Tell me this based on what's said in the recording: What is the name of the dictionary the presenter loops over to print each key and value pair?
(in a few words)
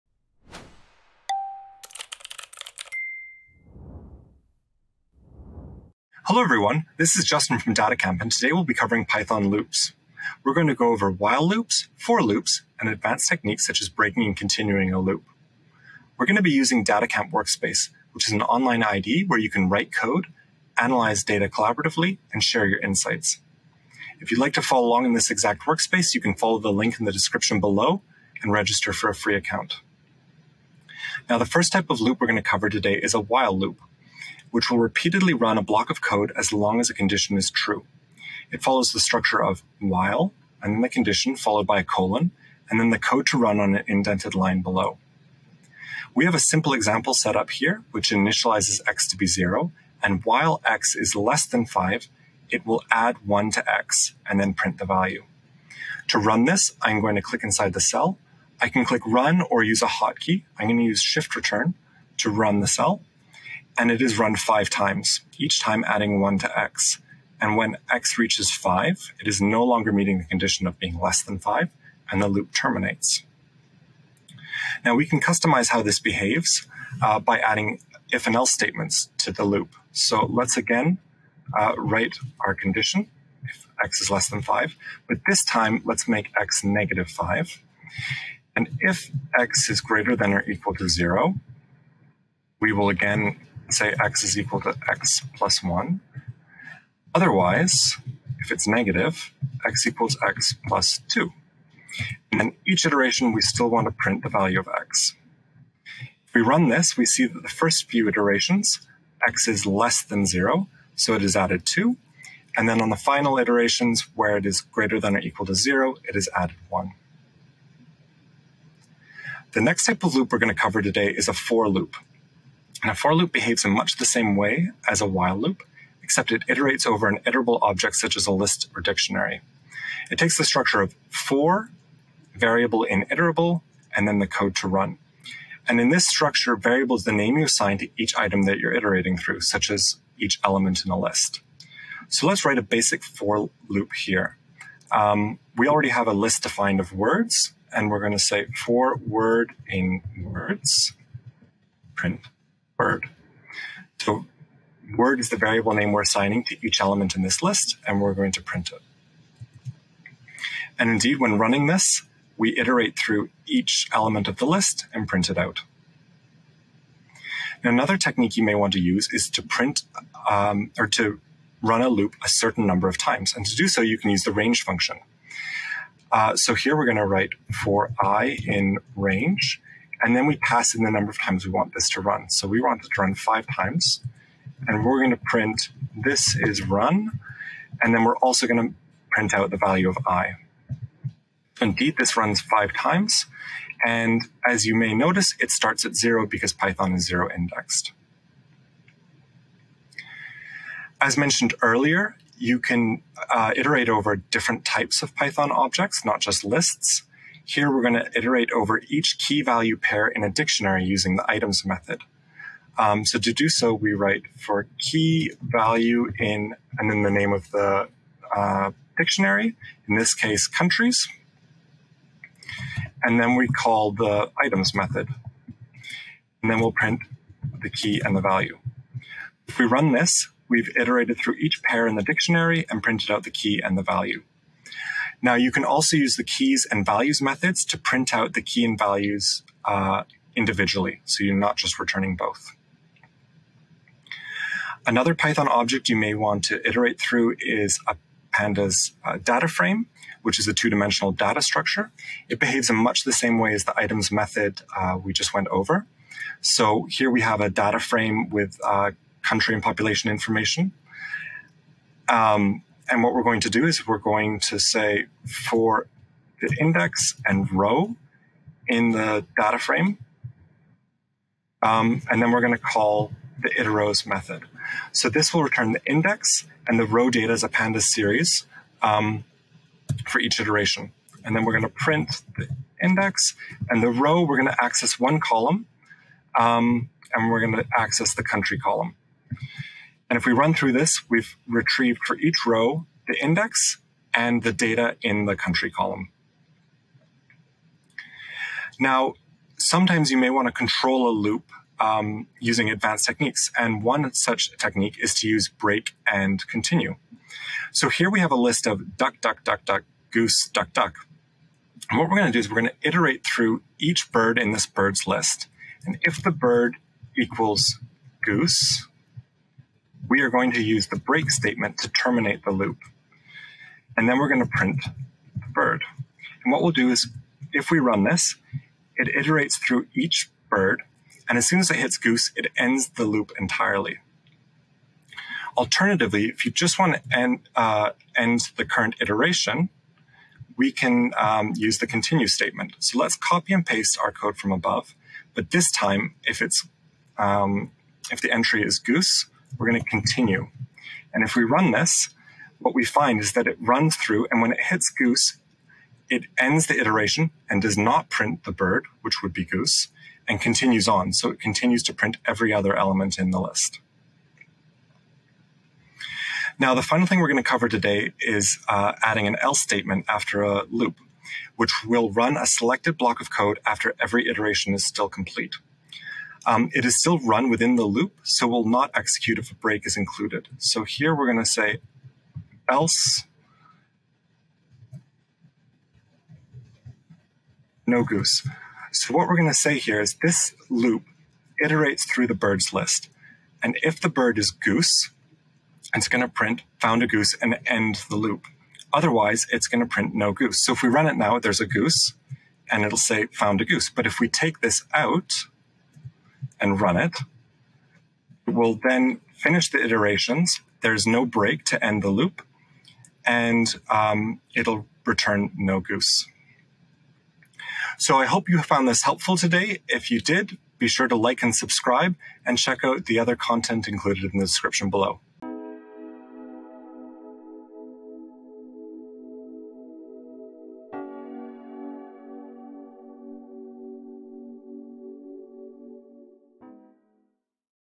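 countries.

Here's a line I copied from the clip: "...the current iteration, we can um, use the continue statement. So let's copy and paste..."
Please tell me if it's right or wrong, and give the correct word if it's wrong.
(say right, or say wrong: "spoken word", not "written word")
right.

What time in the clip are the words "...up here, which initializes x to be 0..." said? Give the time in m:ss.
0:47.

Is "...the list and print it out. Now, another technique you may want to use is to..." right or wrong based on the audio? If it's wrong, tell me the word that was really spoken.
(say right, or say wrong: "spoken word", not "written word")
right.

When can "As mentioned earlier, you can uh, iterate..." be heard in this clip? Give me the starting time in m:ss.
3:20.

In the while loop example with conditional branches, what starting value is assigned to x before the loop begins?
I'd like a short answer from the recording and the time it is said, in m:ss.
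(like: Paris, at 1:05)
-5, at 1:26.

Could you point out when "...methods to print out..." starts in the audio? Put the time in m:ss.
3:57.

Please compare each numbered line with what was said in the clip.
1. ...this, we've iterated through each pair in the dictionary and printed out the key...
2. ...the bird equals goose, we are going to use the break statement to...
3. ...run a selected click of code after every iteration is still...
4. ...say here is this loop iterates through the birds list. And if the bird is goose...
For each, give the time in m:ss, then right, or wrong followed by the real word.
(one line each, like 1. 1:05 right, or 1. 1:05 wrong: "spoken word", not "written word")
1. 3:49 right
2. 5:16 right
3. 6:12 wrong: "block", not "click"
4. 6:29 right.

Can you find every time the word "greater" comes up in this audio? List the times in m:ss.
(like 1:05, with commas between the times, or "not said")
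1:29, 1:54.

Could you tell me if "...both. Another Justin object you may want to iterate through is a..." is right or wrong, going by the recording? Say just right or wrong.
wrong.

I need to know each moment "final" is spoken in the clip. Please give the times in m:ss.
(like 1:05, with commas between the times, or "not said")
1:52, 6:06.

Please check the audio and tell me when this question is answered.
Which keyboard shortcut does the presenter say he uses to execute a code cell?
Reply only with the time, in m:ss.
1:01.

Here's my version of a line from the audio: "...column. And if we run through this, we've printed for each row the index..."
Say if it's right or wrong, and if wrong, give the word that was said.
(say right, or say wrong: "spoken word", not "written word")
wrong: "retrieved", not "printed".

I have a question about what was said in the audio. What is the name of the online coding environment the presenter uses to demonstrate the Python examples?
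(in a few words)
DataCamp Workspace.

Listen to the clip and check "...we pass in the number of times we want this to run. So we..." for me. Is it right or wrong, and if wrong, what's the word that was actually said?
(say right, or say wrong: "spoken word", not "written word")
right.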